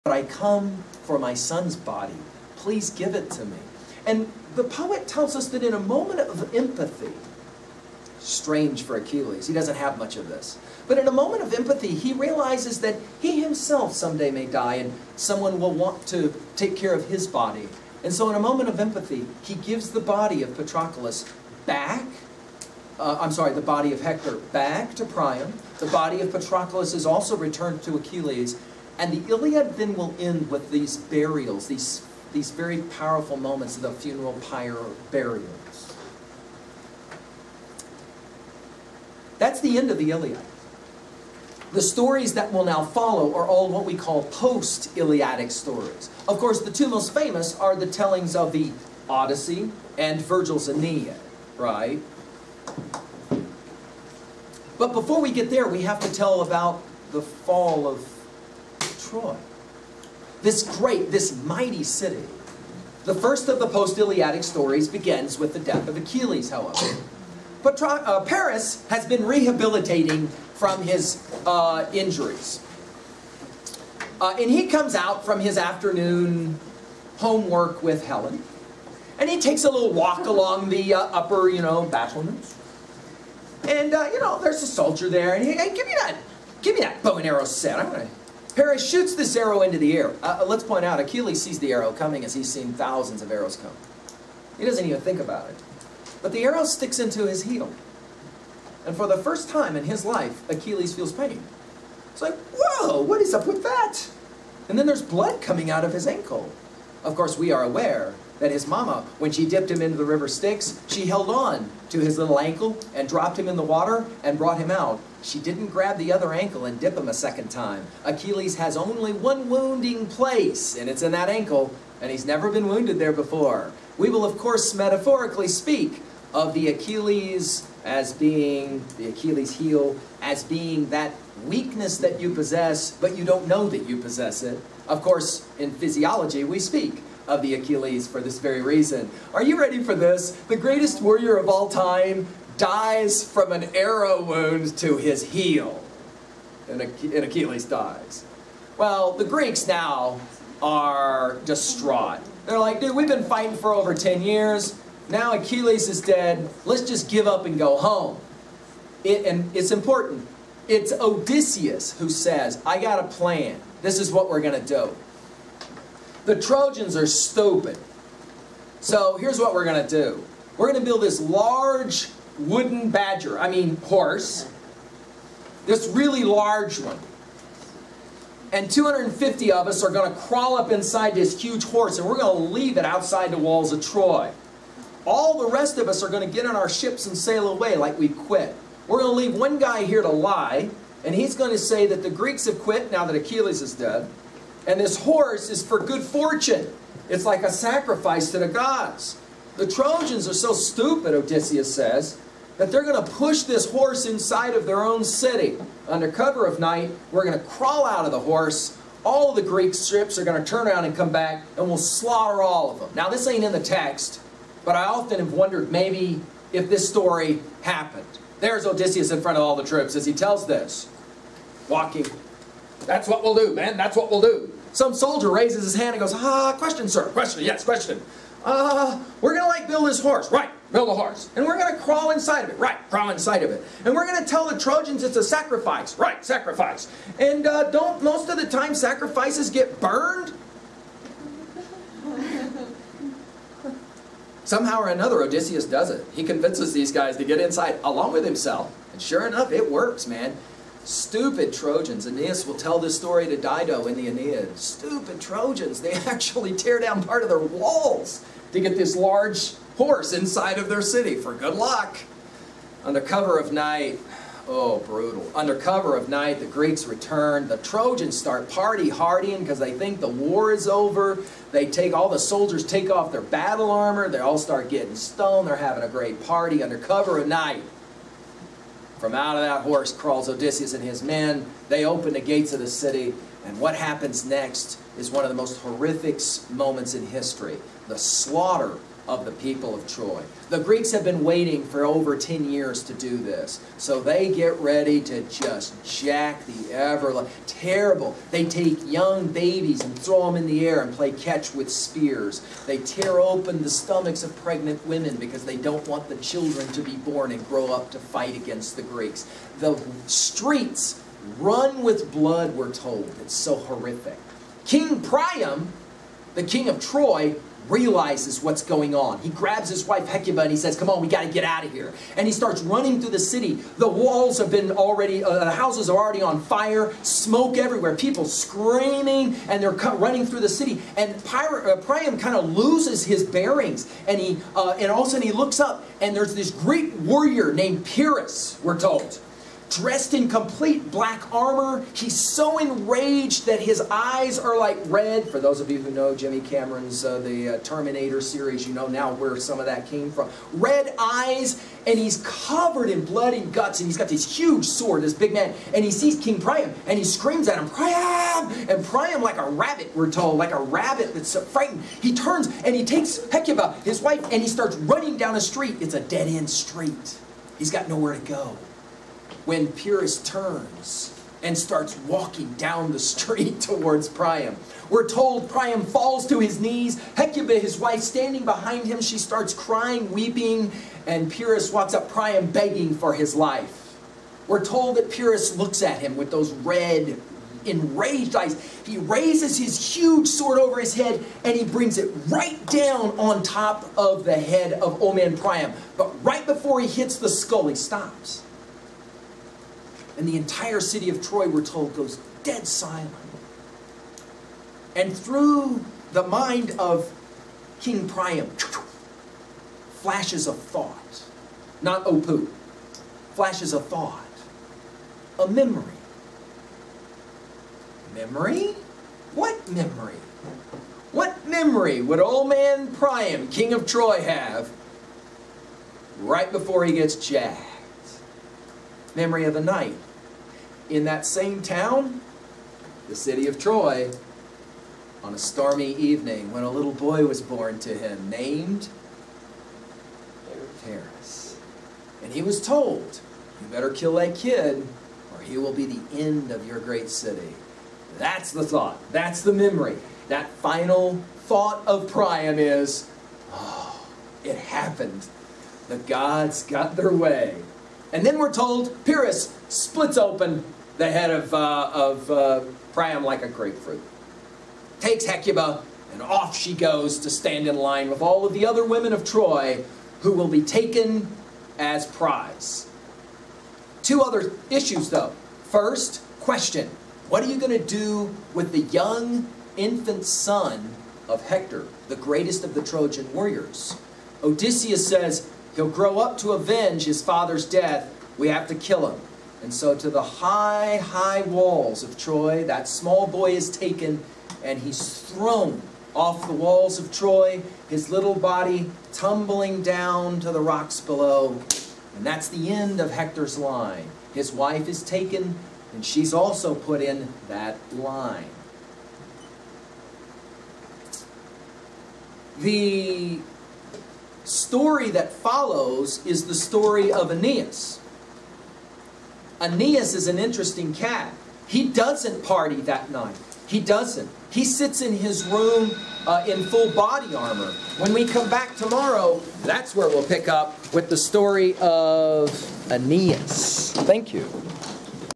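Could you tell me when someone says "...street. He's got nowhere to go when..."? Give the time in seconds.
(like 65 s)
366 s.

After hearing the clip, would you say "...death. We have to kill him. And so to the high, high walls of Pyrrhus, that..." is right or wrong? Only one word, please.
wrong.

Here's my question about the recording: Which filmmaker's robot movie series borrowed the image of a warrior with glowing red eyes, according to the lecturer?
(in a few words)
Jimmy Cameron.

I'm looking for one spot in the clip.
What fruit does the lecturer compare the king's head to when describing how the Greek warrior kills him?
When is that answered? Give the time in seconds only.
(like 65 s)
463 s.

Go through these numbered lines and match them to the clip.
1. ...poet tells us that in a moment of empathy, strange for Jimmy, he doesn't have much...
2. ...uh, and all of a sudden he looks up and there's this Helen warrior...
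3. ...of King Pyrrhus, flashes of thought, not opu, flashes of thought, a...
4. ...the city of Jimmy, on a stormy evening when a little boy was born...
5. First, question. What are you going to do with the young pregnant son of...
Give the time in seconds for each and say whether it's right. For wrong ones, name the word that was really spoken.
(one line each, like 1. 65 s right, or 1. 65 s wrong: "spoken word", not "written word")
1. 4 s wrong: "Achilles", not "Jimmy"
2. 334 s wrong: "Greek", not "Helen"
3. 406 s wrong: "Priam", not "Pyrrhus"
4. 433 s wrong: "Troy", not "Jimmy"
5. 475 s wrong: "infant", not "pregnant".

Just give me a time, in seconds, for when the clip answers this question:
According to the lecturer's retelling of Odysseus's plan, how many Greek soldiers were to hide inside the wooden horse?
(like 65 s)
178 s.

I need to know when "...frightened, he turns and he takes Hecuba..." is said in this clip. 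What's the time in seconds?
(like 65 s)
361 s.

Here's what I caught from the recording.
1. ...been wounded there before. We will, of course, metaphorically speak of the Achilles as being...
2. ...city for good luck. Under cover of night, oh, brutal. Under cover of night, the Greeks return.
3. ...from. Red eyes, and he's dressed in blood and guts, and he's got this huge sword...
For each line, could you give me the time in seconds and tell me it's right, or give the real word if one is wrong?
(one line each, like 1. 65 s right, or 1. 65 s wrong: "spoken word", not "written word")
1. 122 s right
2. 260 s right
3. 350 s wrong: "covered", not "dressed".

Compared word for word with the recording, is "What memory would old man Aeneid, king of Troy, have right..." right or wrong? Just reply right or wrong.
wrong.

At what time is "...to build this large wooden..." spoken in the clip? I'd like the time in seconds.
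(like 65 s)
170 s.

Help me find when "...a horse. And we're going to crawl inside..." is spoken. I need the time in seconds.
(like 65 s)
230 s.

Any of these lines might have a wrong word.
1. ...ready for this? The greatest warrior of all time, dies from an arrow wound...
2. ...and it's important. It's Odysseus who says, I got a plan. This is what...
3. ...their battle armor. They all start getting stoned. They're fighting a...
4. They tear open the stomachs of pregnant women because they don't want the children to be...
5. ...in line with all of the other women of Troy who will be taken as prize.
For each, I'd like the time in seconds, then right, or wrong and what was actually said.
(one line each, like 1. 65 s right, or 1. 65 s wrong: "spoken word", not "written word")
1. 139 s right
2. 159 s right
3. 273 s wrong: "having", not "fighting"
4. 302 s right
5. 467 s right.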